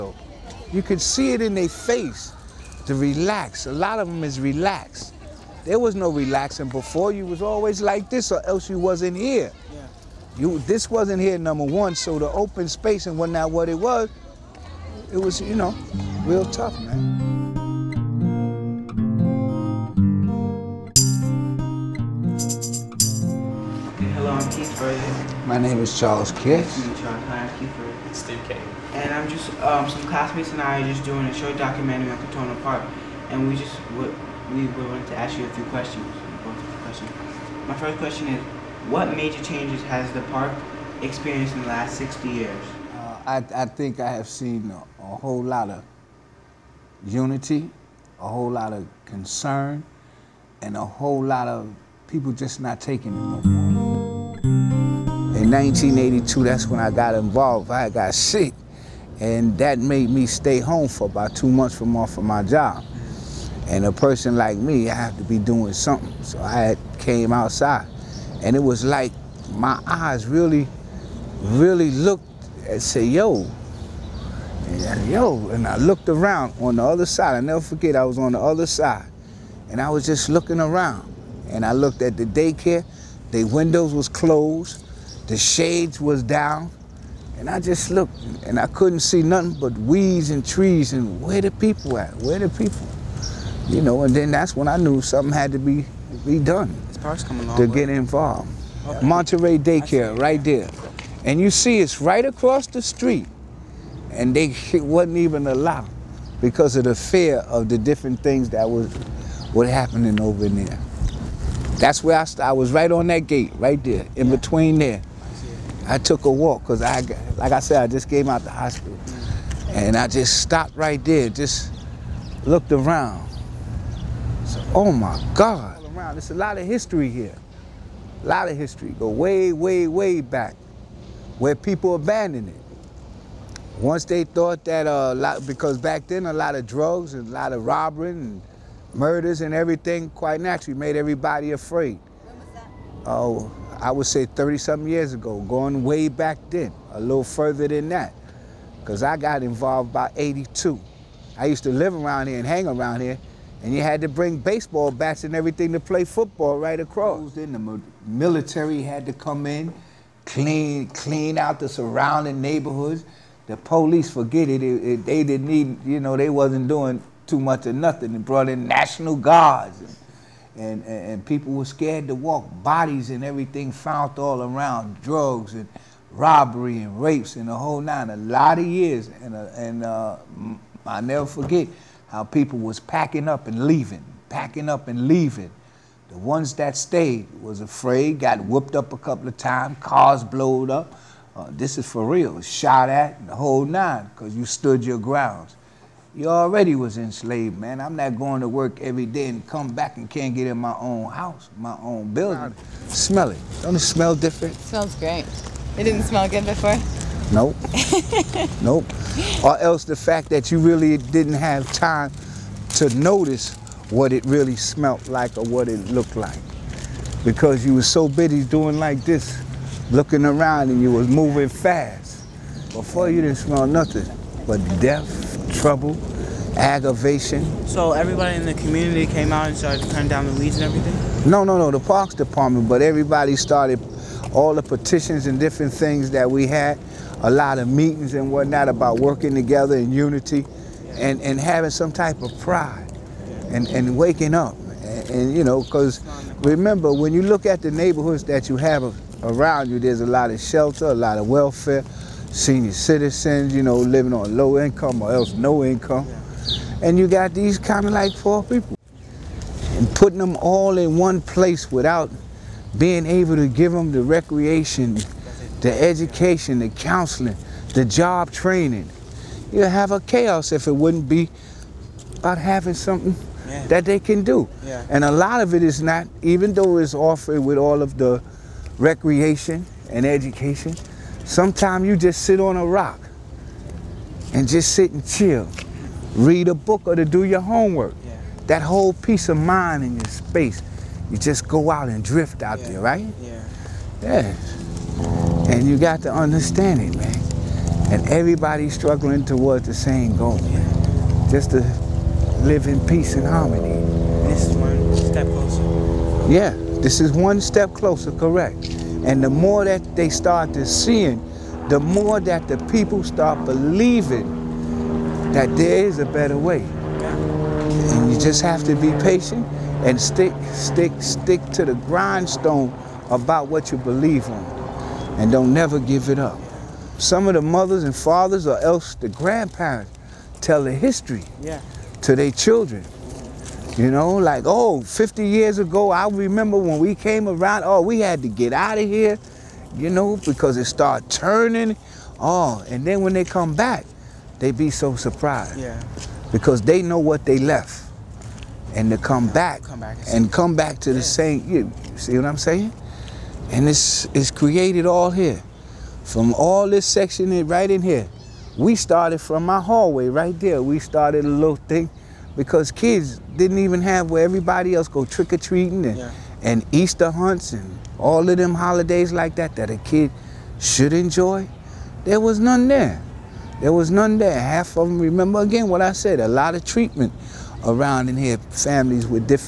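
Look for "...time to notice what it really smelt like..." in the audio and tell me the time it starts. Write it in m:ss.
3:31.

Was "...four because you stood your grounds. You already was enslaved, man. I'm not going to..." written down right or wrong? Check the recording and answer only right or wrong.
wrong.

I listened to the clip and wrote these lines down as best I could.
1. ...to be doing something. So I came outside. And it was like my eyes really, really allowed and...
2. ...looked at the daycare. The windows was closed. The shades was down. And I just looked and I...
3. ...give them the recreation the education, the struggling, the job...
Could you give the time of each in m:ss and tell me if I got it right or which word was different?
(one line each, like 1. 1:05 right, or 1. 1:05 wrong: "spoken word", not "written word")
1. 1:05 wrong: "looked", not "allowed"
2. 1:21 right
3. 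4:23 wrong: "counseling", not "struggling".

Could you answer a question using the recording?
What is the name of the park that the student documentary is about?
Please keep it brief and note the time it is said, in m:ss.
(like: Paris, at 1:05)
Crotona Park, at 0:32.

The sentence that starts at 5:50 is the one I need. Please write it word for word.
the same, you see what I'm saying?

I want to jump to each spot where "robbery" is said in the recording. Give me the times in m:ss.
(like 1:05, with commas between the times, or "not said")
2:17, 2:56.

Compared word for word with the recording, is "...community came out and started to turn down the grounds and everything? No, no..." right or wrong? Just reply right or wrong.
wrong.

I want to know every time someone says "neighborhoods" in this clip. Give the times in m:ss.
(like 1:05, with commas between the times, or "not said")
2:42, 4:07.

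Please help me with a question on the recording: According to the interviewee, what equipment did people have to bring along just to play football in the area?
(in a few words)
Baseball bats.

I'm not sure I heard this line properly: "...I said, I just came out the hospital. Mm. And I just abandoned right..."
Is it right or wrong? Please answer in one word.
wrong.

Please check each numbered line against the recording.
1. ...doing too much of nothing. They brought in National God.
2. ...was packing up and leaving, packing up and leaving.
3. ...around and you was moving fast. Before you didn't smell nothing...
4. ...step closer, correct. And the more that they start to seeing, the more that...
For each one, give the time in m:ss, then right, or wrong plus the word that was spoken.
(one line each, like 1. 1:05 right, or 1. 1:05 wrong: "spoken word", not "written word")
1. 2:46 wrong: "Guards", not "God"
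2. 3:02 right
3. 3:40 right
4. 5:07 right.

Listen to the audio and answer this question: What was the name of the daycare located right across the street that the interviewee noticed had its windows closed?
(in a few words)
Monterey Daycare.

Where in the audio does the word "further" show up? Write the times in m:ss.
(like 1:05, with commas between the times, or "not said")
2:27.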